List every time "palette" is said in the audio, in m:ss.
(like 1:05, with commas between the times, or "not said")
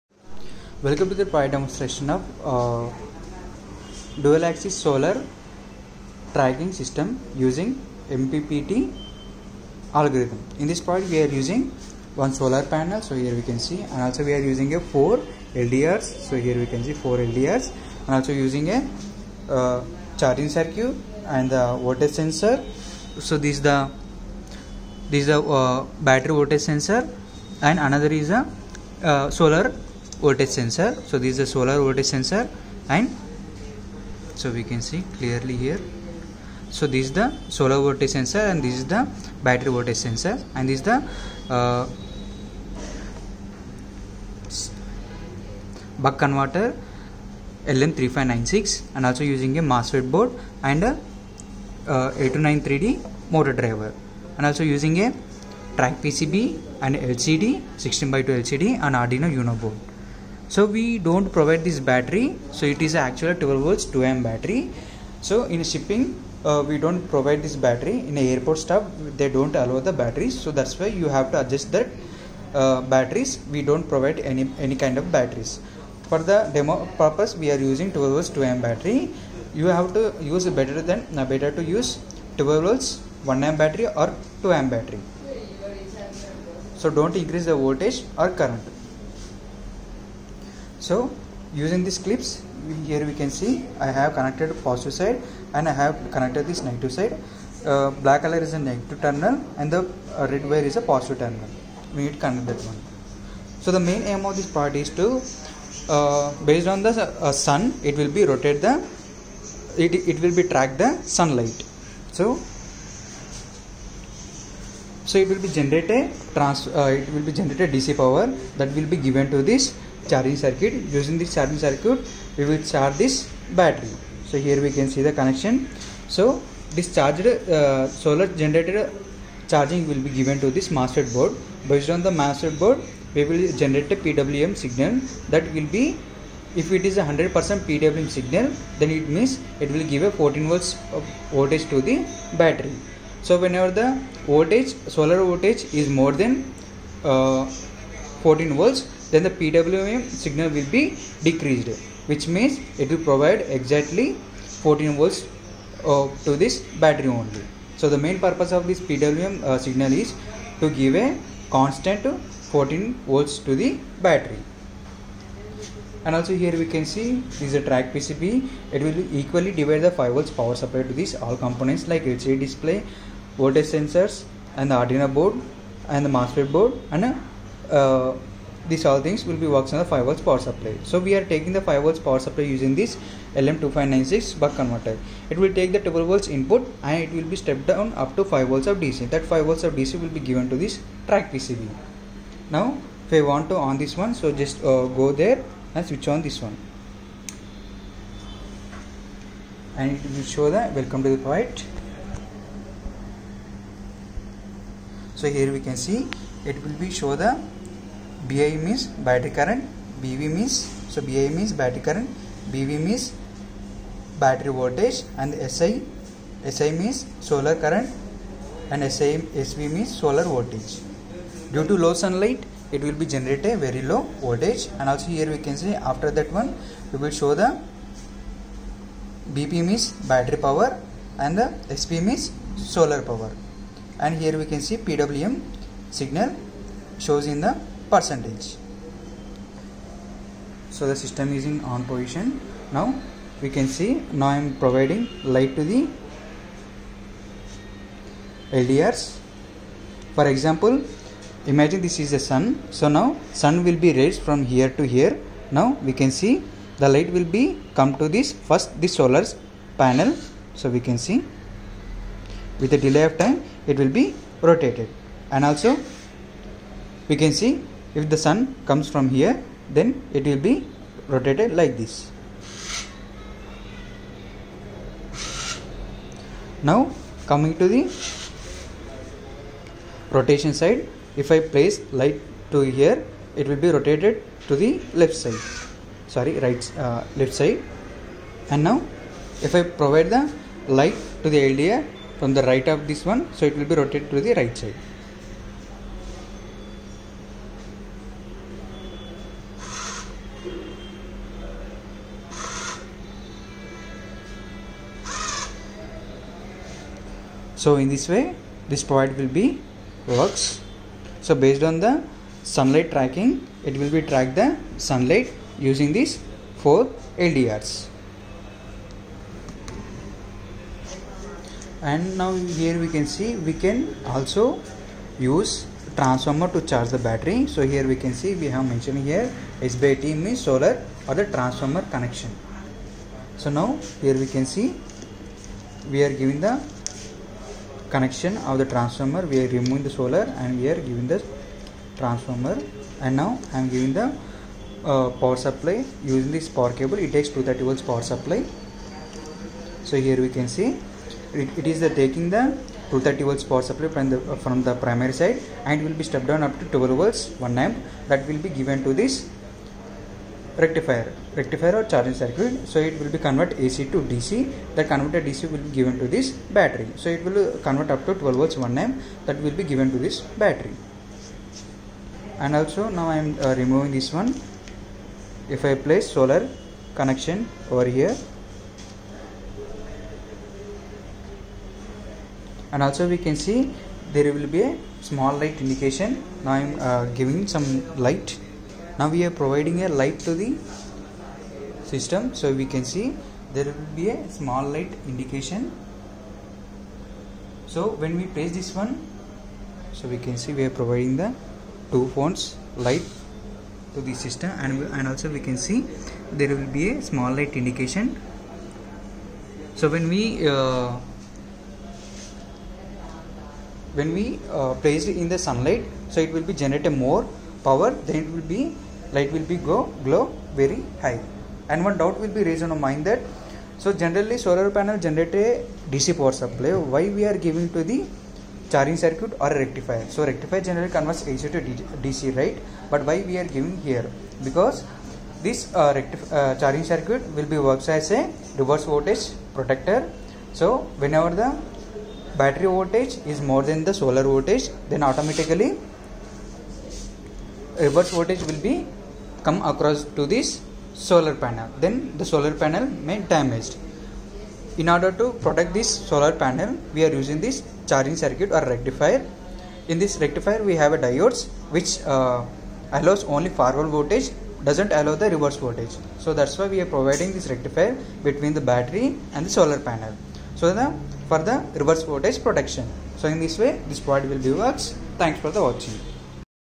not said.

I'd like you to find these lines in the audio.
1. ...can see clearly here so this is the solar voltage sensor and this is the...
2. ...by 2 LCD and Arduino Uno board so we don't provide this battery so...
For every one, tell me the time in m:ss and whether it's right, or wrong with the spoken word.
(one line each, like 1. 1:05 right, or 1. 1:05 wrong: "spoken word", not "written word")
1. 0:34 right
2. 0:58 right.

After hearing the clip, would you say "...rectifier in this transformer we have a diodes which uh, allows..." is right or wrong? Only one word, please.
wrong.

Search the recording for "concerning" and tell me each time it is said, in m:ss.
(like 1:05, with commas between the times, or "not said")
not said.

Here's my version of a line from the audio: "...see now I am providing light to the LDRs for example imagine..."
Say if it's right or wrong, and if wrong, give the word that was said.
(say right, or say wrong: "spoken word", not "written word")
right.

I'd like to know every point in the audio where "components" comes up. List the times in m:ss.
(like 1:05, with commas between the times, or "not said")
2:51.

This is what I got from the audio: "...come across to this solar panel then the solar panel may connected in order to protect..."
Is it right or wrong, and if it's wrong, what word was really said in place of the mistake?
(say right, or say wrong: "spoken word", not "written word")
wrong: "damaged", not "connected".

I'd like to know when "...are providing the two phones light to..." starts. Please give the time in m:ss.
6:40.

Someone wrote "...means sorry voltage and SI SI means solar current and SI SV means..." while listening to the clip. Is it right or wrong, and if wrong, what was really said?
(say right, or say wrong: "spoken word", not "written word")
wrong: "battery", not "sorry".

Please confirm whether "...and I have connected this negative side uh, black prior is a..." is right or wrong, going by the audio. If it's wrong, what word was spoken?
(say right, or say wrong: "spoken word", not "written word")
wrong: "color", not "prior".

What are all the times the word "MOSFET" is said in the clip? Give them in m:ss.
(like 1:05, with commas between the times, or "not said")
0:49, 2:56.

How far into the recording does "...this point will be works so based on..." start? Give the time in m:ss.
5:08.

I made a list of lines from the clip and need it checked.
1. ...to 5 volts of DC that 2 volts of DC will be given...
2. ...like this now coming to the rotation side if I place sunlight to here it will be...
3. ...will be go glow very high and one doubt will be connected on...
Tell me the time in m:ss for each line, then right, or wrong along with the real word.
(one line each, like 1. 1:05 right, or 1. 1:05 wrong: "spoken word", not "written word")
1. 3:08 wrong: "5", not "2"
2. 4:31 wrong: "light", not "sunlight"
3. 6:59 wrong: "raised", not "connected".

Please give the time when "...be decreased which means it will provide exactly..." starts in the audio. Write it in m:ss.
2:30.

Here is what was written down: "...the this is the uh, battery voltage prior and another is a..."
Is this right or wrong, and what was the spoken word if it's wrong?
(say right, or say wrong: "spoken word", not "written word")
wrong: "sensor", not "prior".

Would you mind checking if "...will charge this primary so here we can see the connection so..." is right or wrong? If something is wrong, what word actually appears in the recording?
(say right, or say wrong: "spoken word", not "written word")
wrong: "battery", not "primary".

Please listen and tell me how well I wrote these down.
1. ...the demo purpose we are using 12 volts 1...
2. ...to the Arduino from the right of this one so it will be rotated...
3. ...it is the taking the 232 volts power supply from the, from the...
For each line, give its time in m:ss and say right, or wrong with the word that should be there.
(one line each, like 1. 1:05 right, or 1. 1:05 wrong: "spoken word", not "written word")
1. 1:16 wrong: "2", not "1"
2. 4:51 wrong: "LDR", not "Arduino"
3. 5:51 wrong: "230", not "232".